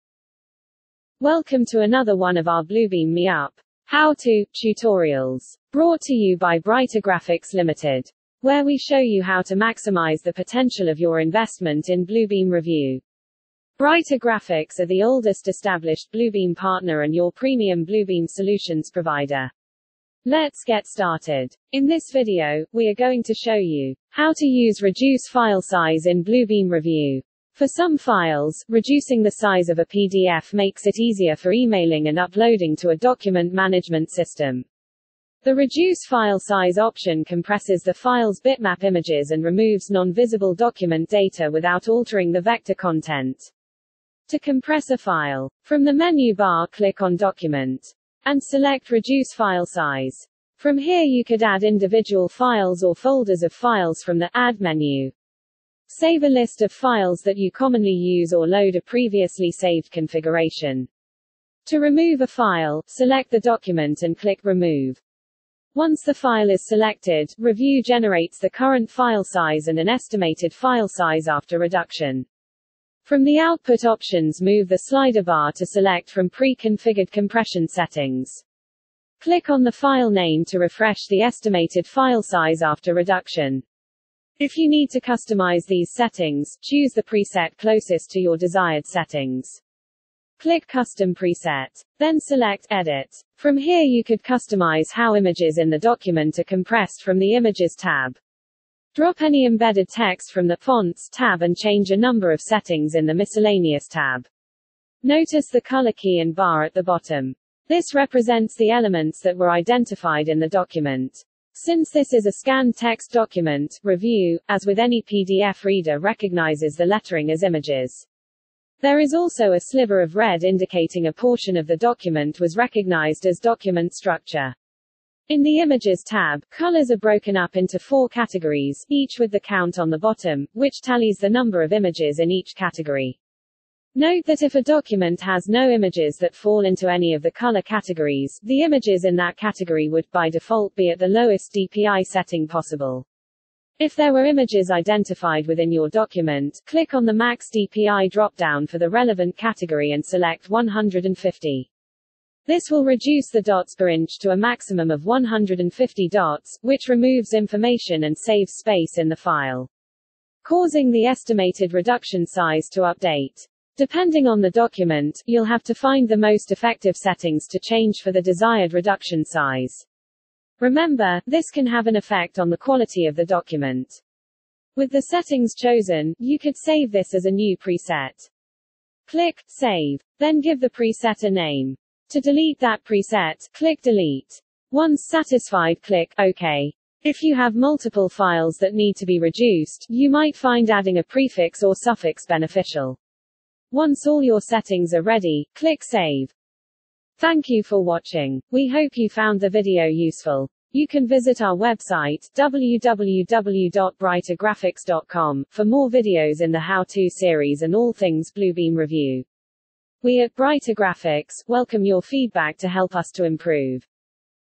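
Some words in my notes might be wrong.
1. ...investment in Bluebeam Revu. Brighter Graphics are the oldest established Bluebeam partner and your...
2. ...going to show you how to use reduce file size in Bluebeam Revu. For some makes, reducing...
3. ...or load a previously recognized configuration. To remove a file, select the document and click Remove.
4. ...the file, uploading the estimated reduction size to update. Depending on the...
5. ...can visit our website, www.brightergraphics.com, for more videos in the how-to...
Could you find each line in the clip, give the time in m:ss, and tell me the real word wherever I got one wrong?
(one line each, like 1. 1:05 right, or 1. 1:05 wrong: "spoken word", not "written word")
1. 0:11 right
2. 0:22 wrong: "files", not "makes"
3. 0:58 wrong: "saved", not "recognized"
4. 2:39 wrong: "causing", not "uploading"
5. 3:20 right.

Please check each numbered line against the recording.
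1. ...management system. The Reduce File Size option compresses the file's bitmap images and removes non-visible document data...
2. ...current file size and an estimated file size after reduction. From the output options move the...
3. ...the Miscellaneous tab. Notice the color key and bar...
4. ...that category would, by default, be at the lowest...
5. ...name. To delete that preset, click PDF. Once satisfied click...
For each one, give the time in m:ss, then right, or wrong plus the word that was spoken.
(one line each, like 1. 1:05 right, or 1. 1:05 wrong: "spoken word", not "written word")
1. 0:33 right
2. 1:08 right
3. 1:43 right
4. 2:19 right
5. 3:01 wrong: "Delete", not "PDF".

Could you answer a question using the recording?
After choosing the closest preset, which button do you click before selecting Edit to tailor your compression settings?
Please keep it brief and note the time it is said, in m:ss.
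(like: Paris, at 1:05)
Custom Preset, at 1:30.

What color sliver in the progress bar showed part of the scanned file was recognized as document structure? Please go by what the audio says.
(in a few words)
red.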